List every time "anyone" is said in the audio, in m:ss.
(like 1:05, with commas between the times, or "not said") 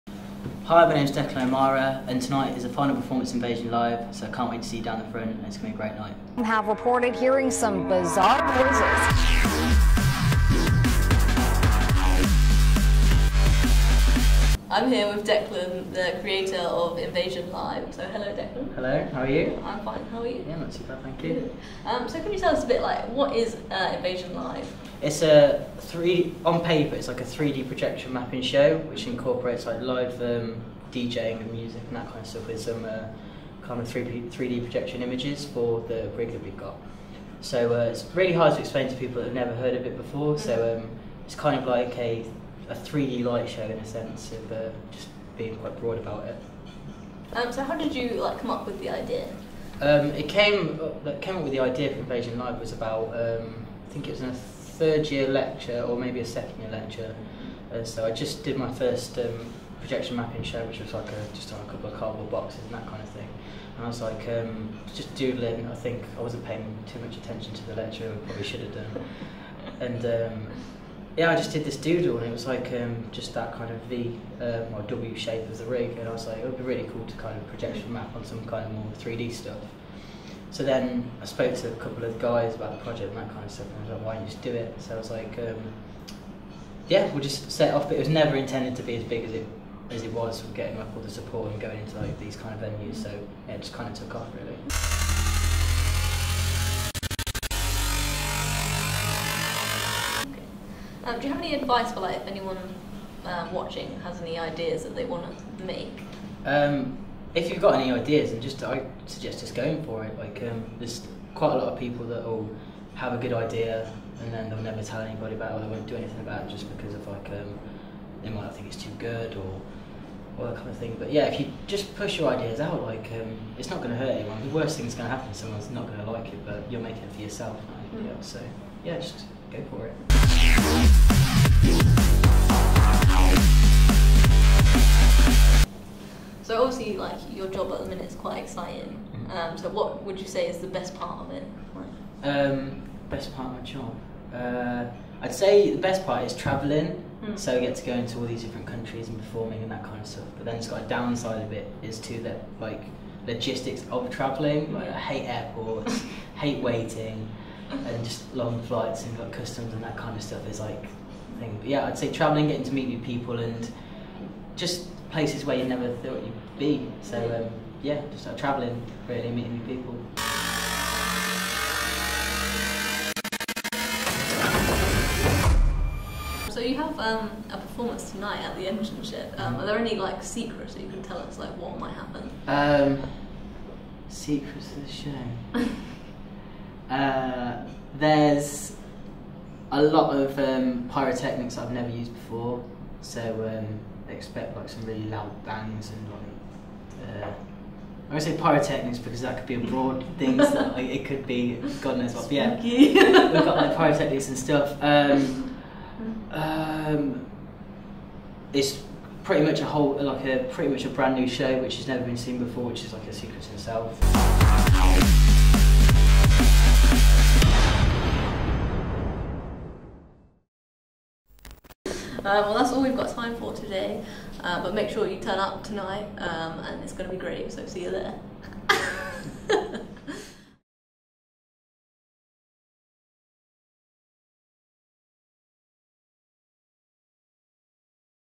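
1:42, 2:04.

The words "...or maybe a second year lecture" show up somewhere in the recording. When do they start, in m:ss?
0:55.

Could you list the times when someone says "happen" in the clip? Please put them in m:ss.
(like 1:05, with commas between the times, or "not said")
2:05, 3:01.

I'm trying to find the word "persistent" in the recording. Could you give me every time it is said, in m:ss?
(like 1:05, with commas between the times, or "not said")
not said.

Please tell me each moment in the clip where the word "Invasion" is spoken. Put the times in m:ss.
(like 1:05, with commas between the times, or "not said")
0:03, 0:16, 0:23, 0:51.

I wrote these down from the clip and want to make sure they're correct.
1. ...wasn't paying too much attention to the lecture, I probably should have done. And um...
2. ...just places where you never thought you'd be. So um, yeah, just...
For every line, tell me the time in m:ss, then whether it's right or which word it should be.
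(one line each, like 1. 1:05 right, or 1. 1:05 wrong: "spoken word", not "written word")
1. 1:06 right
2. 2:44 right.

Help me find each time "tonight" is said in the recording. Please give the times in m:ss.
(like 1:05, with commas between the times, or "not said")
0:02, 2:58, 3:45.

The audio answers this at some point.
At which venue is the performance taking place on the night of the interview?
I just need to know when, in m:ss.
2:58.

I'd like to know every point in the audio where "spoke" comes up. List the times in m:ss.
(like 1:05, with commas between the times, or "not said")
1:21.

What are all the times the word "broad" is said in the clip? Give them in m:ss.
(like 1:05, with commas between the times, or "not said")
0:45, 3:19.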